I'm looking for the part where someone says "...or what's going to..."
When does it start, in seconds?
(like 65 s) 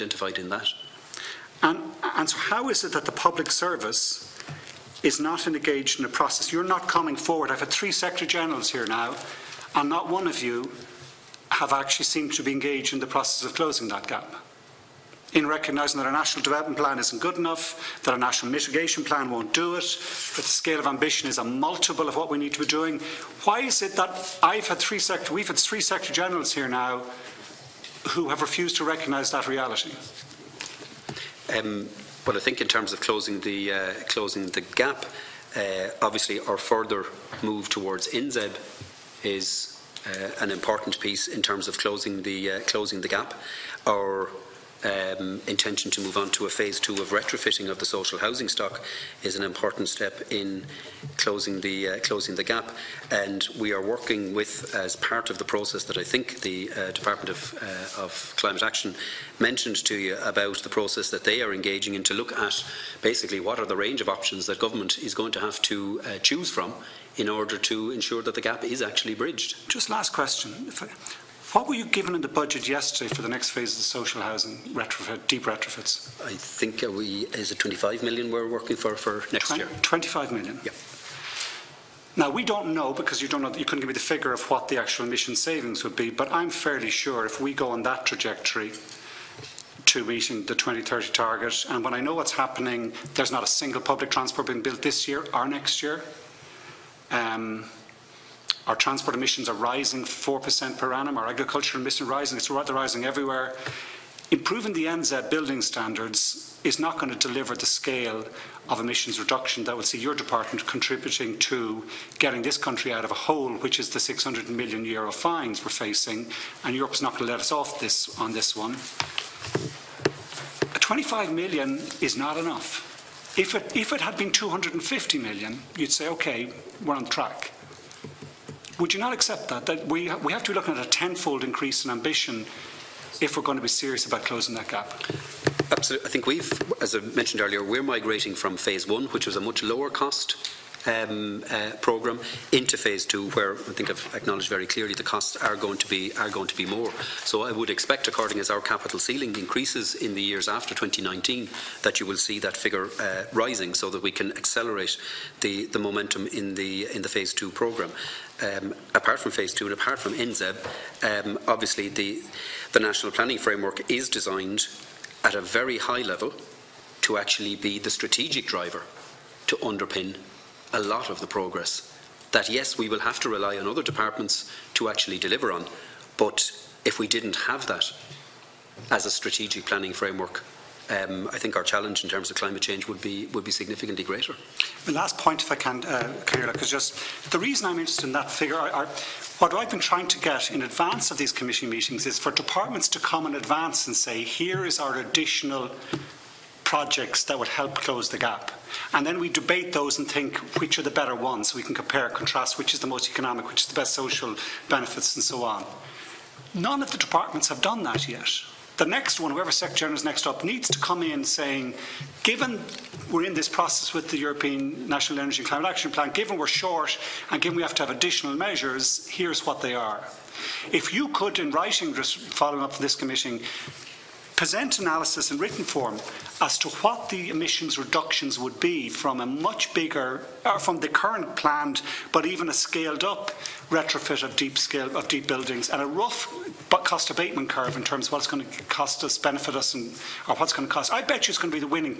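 240 s.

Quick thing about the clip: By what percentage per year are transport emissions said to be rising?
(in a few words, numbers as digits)
4%.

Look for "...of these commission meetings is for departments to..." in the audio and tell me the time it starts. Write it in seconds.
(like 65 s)
191 s.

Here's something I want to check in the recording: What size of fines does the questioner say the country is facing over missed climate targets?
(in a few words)
600 million euro.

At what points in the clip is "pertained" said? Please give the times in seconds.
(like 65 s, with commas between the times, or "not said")
not said.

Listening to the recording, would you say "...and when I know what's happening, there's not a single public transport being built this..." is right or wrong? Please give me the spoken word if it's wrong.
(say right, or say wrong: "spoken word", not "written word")
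right.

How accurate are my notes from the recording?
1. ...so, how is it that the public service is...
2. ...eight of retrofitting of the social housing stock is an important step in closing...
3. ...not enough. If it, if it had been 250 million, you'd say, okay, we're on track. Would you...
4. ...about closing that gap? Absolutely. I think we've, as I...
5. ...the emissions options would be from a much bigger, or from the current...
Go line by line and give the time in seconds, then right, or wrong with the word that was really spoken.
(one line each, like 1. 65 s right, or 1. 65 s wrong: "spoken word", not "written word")
1. 2 s right
2. 46 s wrong: "two", not "eight"
3. 122 s right
4. 134 s right
5. 227 s wrong: "reductions", not "options".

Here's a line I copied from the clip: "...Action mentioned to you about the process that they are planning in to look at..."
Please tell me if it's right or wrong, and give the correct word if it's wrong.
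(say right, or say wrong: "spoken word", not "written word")
wrong: "engaging", not "planning".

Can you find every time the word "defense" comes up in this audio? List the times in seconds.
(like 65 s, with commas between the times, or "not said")
not said.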